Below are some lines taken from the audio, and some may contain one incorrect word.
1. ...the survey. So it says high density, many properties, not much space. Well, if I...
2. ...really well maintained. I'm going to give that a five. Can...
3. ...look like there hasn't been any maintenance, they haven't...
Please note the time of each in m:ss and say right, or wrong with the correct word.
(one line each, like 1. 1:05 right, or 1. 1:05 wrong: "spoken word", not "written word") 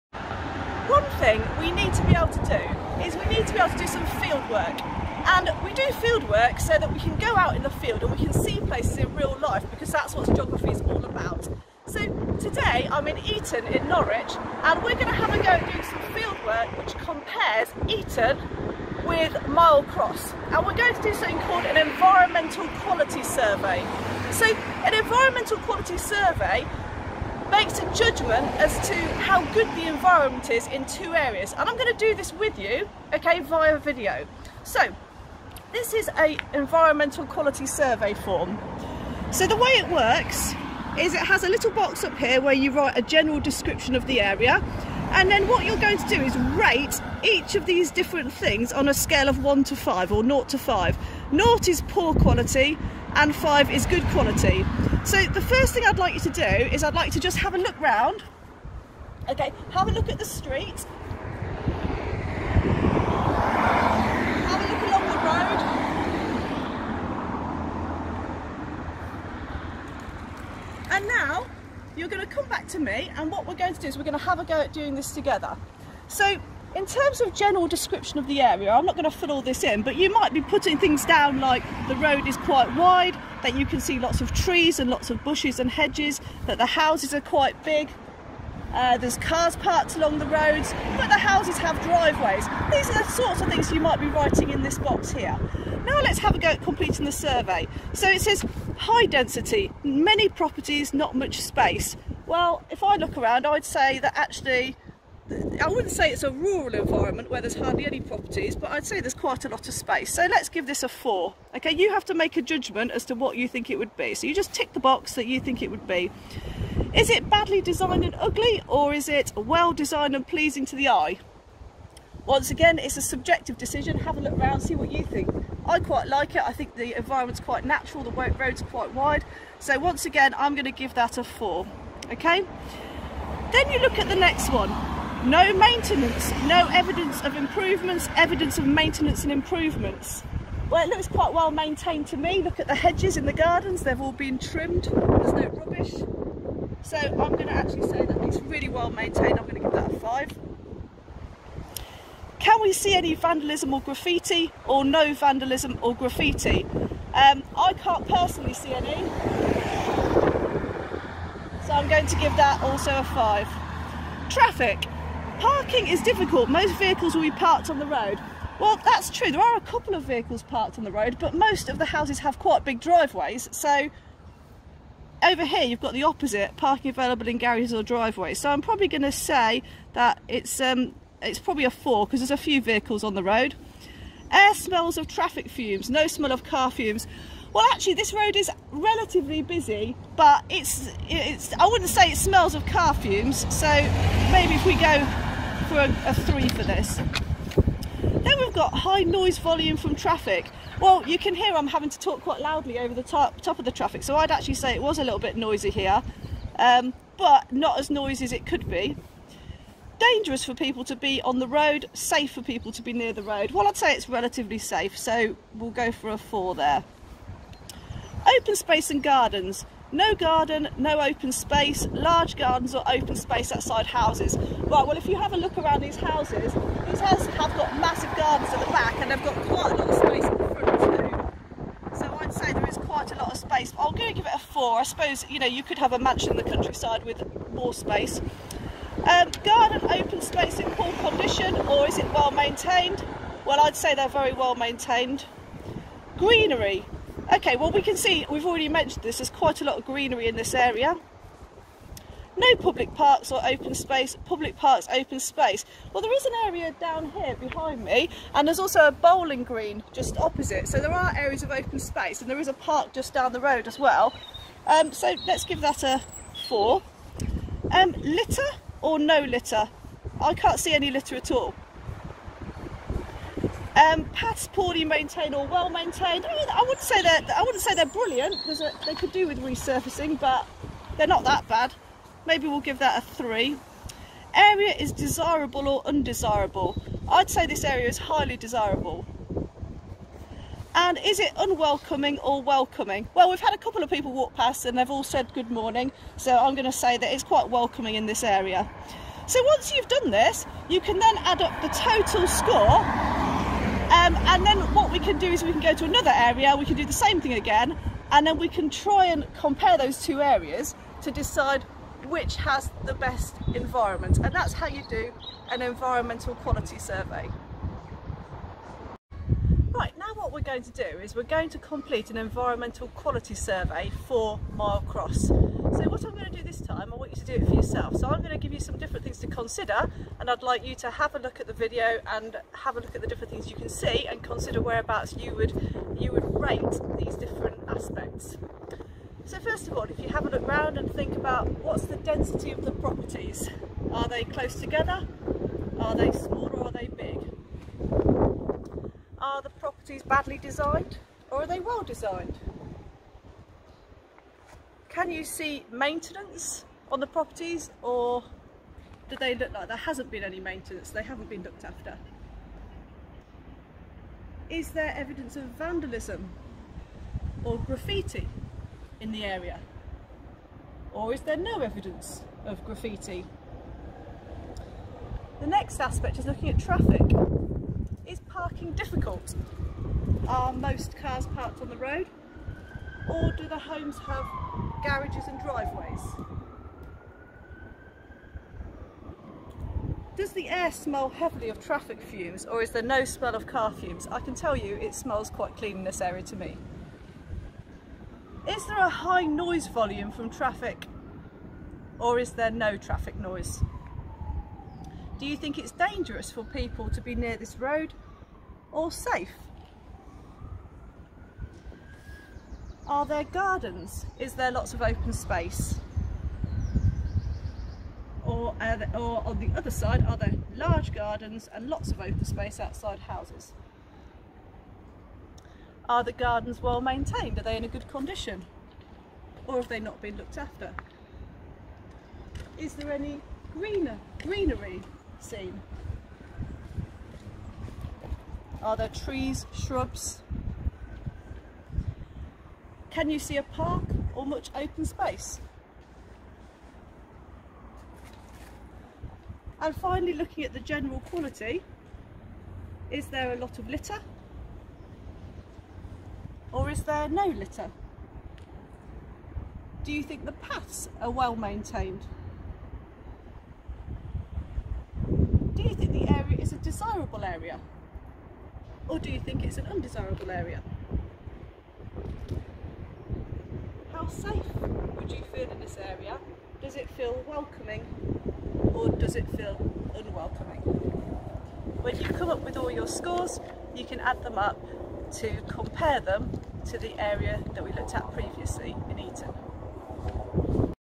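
1. 1:37 right
2. 2:28 right
3. 5:59 right.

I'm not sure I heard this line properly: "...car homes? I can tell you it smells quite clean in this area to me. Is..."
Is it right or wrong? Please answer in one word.
wrong.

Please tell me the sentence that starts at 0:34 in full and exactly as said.
So, this is a environmental quality survey form.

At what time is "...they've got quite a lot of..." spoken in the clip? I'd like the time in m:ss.
3:49.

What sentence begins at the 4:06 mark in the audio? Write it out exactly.
Greenery, Okay, well we can see, we've already mentioned this, there's quite a lot of greenery in this area.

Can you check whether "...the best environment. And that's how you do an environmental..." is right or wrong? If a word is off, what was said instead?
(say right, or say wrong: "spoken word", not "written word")
right.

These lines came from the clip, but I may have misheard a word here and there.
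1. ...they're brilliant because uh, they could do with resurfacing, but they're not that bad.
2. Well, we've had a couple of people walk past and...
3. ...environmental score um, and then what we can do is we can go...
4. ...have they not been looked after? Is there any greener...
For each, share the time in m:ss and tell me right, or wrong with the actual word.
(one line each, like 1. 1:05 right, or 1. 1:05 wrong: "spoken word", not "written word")
1. 4:37 right
2. 4:53 right
3. 5:01 wrong: "total", not "environmental"
4. 7:09 right.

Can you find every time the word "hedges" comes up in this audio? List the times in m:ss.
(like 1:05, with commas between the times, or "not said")
1:25, 2:22.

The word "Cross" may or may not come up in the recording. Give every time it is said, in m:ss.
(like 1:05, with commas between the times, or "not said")
0:19, 5:24.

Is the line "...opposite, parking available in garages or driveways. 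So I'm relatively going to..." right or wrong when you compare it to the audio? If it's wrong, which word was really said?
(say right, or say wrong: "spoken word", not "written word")
wrong: "probably", not "relatively".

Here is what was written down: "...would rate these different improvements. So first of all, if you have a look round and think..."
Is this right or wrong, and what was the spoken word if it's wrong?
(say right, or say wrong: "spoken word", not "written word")
wrong: "aspects", not "improvements".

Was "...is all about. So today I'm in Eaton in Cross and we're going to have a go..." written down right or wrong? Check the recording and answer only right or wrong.
wrong.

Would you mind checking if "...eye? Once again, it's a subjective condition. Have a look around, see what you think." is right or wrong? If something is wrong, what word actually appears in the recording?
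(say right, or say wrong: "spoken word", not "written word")
wrong: "decision", not "condition".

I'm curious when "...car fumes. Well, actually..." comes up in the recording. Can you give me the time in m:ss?
3:06.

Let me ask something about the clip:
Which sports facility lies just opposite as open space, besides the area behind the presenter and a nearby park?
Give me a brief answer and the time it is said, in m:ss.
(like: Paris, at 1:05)
Bowling green, at 4:18.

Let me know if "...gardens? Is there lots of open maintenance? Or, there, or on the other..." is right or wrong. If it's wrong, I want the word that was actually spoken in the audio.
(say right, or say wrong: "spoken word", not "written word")
wrong: "space", not "maintenance".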